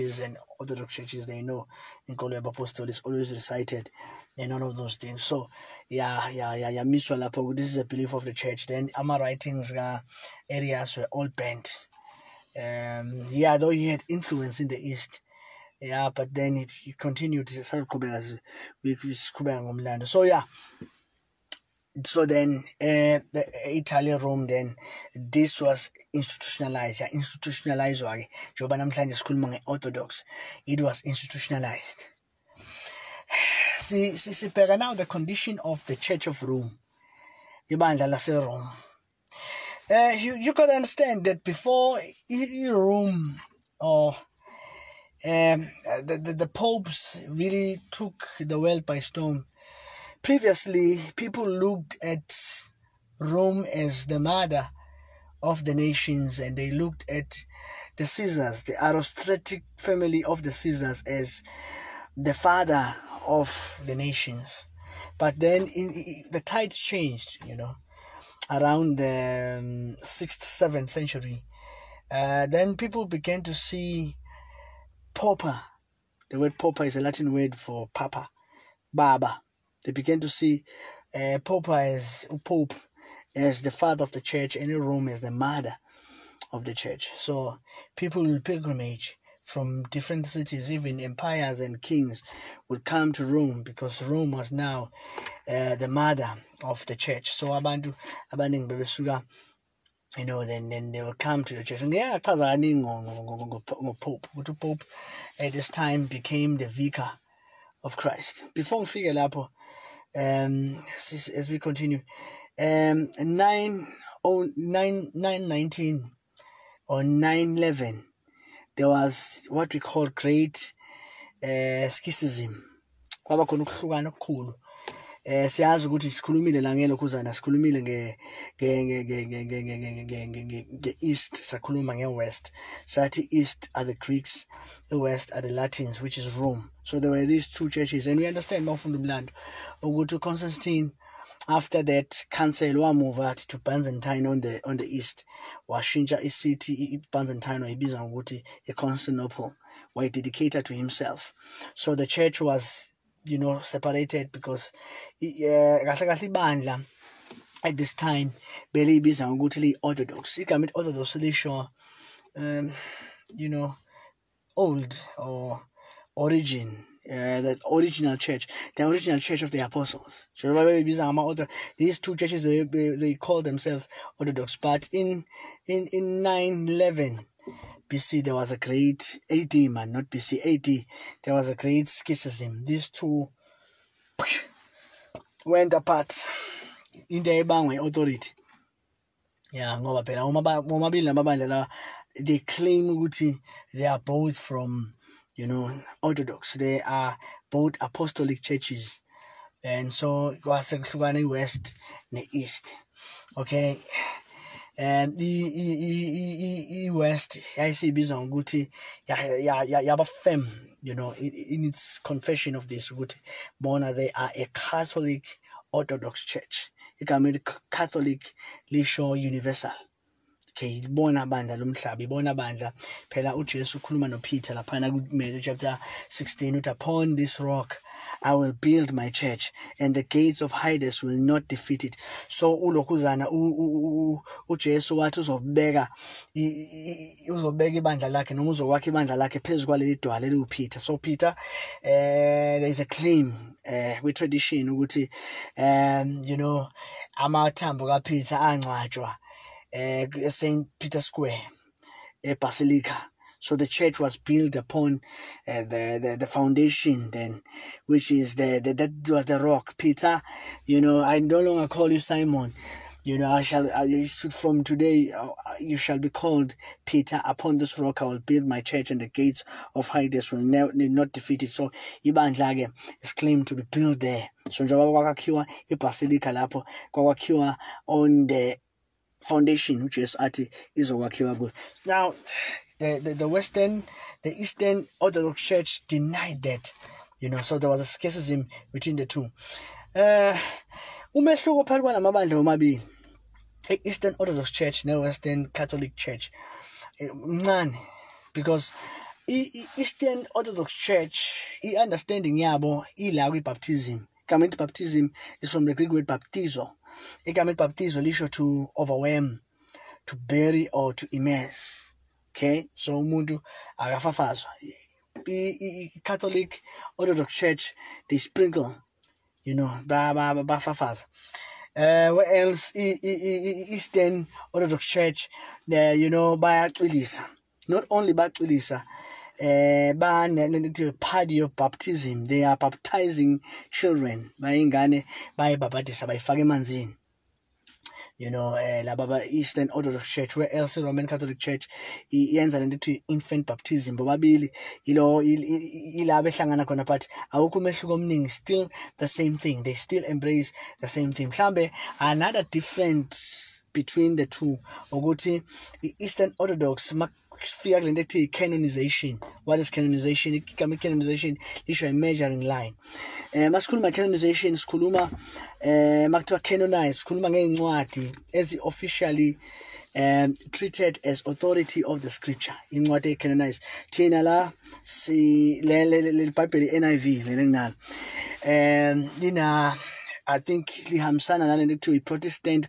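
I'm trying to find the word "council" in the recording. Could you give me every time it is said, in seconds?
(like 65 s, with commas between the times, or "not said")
142 s.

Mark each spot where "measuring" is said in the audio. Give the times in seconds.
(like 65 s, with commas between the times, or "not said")
361 s.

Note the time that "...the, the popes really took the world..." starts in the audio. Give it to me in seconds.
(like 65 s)
46 s.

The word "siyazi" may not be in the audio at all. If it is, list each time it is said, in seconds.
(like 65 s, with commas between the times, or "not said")
125 s.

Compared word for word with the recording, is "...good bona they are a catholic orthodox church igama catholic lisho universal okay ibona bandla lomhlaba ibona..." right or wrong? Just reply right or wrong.
right.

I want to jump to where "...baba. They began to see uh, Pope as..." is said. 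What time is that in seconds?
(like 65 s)
78 s.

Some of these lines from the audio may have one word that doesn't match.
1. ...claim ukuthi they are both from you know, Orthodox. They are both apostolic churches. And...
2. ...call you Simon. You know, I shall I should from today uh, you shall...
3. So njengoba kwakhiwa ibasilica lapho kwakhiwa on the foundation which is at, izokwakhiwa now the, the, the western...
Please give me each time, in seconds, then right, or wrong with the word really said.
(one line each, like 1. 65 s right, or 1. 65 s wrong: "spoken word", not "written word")
1. 192 s right
2. 261 s right
3. 274 s right.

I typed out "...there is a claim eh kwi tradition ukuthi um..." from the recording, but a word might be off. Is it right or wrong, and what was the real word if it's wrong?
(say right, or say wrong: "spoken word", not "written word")
right.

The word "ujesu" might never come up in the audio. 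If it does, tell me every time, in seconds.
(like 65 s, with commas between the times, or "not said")
223 s, 234 s.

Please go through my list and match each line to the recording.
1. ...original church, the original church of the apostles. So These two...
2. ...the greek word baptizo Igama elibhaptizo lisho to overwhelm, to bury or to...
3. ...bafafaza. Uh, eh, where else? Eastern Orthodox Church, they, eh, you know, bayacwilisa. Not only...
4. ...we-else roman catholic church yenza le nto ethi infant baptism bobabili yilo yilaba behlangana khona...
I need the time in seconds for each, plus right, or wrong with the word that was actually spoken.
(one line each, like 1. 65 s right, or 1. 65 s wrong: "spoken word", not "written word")
1. 167 s right
2. 305 s right
3. 319 s right
4. 340 s right.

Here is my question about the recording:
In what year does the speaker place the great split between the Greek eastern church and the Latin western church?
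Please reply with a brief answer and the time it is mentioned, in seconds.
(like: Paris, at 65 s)
911, at 176 s.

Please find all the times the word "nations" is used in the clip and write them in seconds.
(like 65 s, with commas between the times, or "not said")
55 s, 63 s.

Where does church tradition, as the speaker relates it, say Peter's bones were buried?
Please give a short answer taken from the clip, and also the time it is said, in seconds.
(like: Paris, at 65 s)
St. Peter's Square, at 250 s.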